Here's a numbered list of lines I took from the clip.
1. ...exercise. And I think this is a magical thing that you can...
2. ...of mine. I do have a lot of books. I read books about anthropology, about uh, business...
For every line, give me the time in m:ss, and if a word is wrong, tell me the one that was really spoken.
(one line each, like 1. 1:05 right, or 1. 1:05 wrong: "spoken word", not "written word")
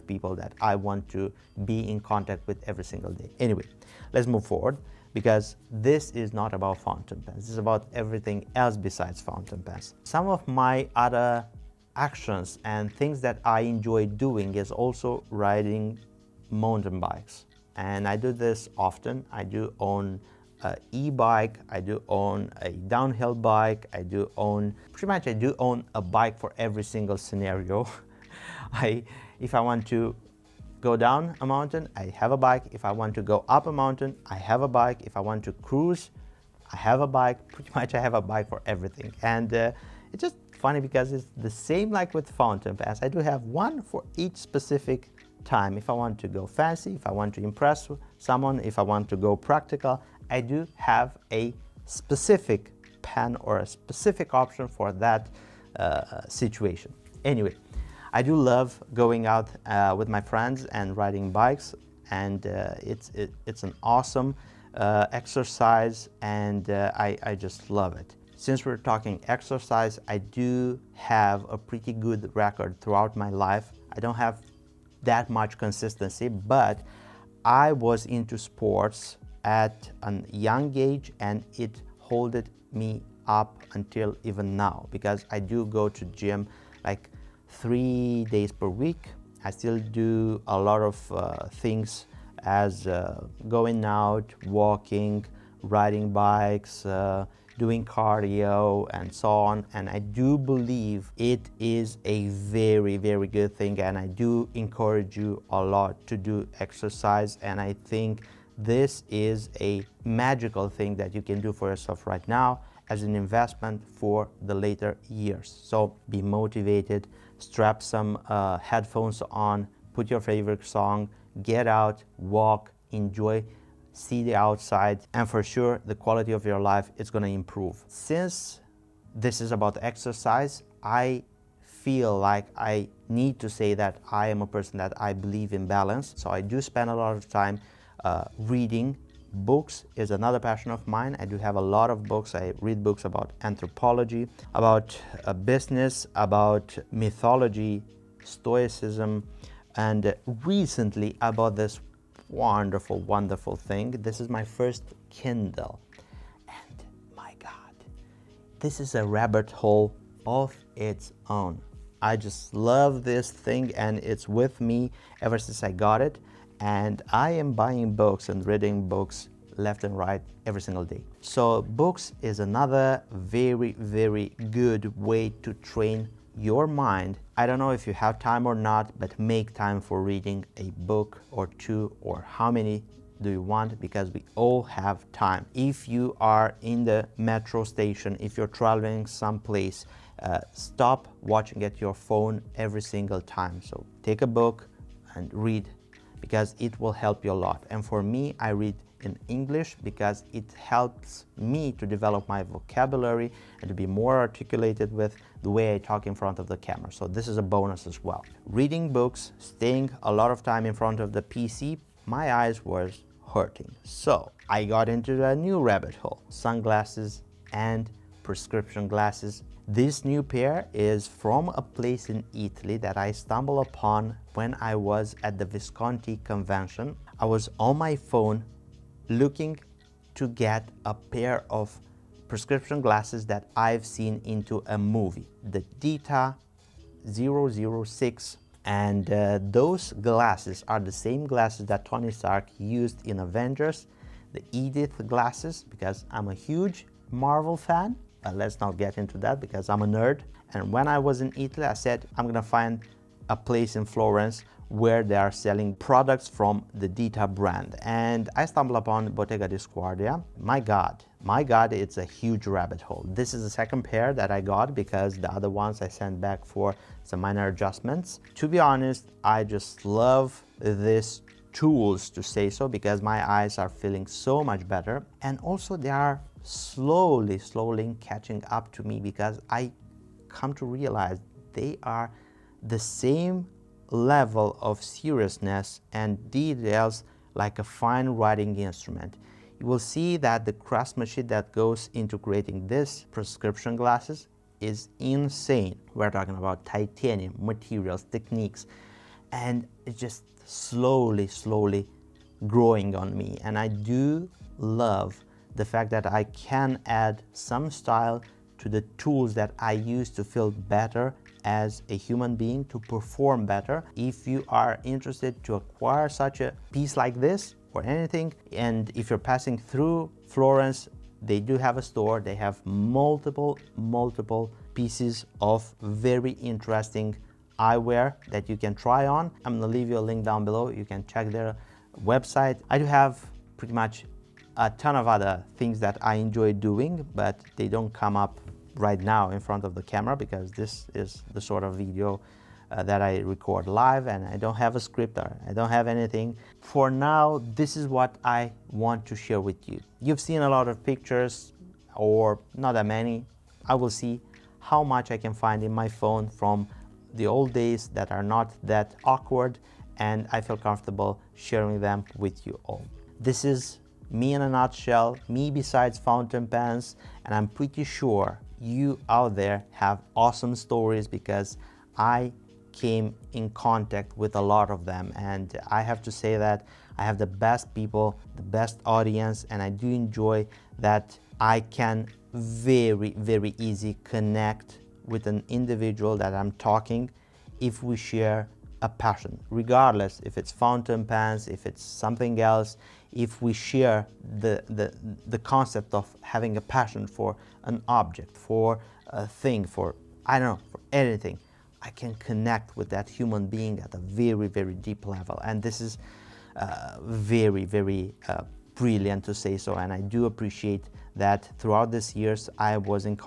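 1. 1:46 right
2. 2:20 right.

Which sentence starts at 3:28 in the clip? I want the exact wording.
Reading books, staying a lot of time in front of the PC, my eyes were hurting.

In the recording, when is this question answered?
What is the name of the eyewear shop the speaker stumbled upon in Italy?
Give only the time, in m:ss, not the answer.
4:19.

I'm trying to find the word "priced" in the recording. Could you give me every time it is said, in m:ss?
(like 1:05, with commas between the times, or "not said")
not said.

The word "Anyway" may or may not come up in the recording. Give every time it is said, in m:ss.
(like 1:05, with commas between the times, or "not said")
0:03, 0:57.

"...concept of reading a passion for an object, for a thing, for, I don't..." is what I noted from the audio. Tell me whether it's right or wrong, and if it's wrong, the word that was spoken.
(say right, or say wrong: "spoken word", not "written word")
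wrong: "having", not "reading".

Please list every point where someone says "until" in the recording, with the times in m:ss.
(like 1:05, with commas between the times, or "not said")
1:23.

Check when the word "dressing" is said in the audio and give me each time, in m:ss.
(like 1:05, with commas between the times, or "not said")
not said.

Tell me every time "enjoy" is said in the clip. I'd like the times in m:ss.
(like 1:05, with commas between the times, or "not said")
0:13, 2:02, 5:36, 6:19.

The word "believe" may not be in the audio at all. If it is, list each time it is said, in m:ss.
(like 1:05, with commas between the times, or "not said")
1:40, 2:15.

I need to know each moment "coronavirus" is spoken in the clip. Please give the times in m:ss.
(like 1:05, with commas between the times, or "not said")
not said.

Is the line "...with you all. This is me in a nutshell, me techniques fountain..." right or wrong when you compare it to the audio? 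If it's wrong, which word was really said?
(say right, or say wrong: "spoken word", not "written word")
wrong: "besides", not "techniques".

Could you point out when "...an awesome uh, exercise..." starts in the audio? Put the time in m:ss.
1:03.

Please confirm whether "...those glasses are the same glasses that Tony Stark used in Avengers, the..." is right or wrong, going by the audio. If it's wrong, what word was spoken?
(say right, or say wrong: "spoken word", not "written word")
right.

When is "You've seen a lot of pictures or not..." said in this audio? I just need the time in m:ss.
5:50.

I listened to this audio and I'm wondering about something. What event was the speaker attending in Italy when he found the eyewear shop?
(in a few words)
Visconti convention.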